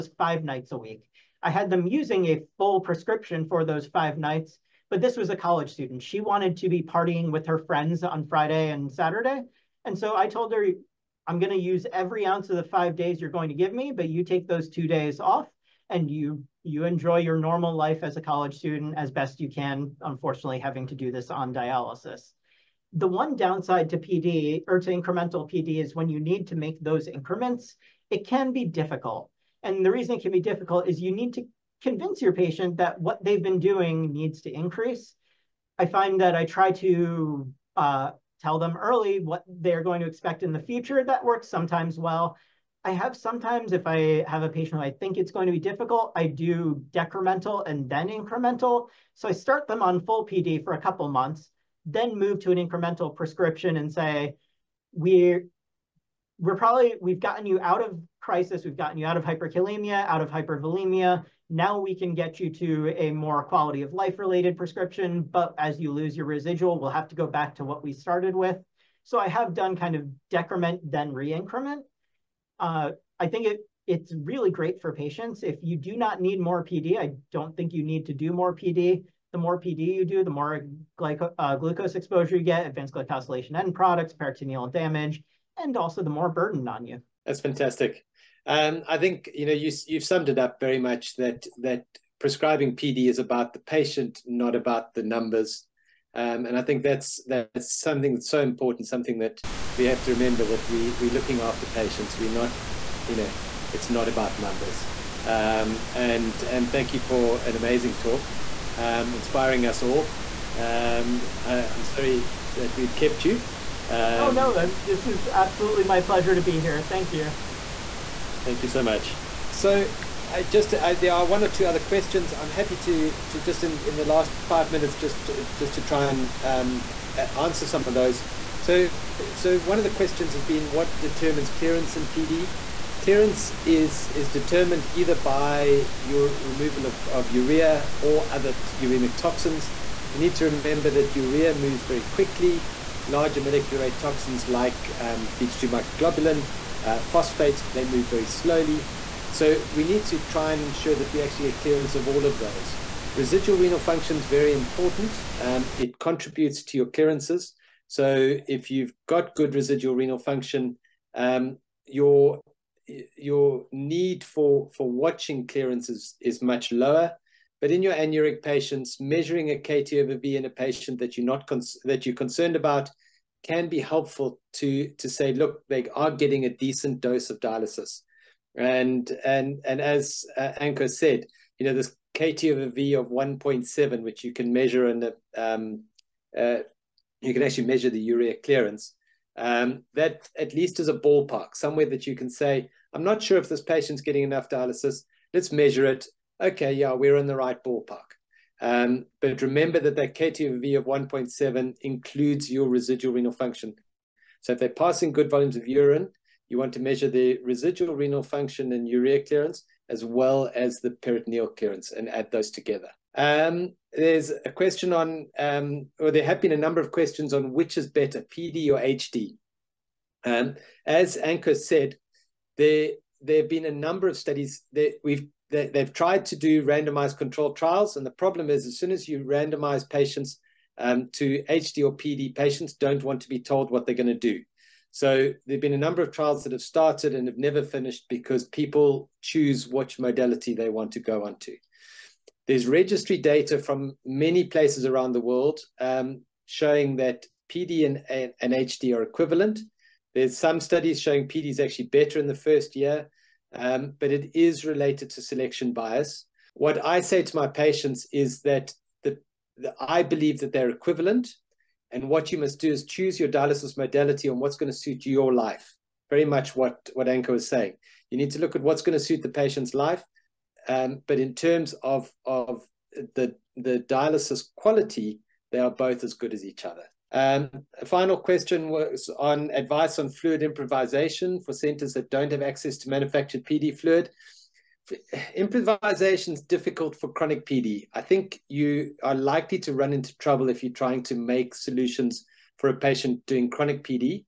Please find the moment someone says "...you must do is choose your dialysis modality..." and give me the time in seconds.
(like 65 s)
262 s.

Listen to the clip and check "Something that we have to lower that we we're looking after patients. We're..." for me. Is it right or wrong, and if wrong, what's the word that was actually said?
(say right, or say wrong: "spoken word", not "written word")
wrong: "remember", not "lower".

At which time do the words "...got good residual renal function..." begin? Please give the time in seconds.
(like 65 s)
159 s.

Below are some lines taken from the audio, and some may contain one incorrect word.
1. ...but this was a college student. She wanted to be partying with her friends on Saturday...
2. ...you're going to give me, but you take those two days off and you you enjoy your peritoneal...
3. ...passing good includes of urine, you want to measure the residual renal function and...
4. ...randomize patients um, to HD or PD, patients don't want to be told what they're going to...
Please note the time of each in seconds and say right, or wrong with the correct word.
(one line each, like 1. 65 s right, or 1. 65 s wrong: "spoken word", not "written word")
1. 4 s wrong: "Friday", not "Saturday"
2. 13 s wrong: "normal", not "peritoneal"
3. 204 s wrong: "volumes", not "includes"
4. 229 s right.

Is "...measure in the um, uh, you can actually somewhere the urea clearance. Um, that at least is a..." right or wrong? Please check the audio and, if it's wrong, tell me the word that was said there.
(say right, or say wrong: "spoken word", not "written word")
wrong: "measure", not "somewhere".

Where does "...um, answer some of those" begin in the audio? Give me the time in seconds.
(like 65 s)
126 s.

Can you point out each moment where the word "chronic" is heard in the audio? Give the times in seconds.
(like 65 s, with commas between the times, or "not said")
287 s, 293 s.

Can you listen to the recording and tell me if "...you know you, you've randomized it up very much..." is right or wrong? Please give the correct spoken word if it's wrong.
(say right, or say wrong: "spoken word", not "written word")
wrong: "summed", not "randomized".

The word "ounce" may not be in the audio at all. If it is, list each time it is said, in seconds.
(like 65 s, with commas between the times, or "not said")
12 s.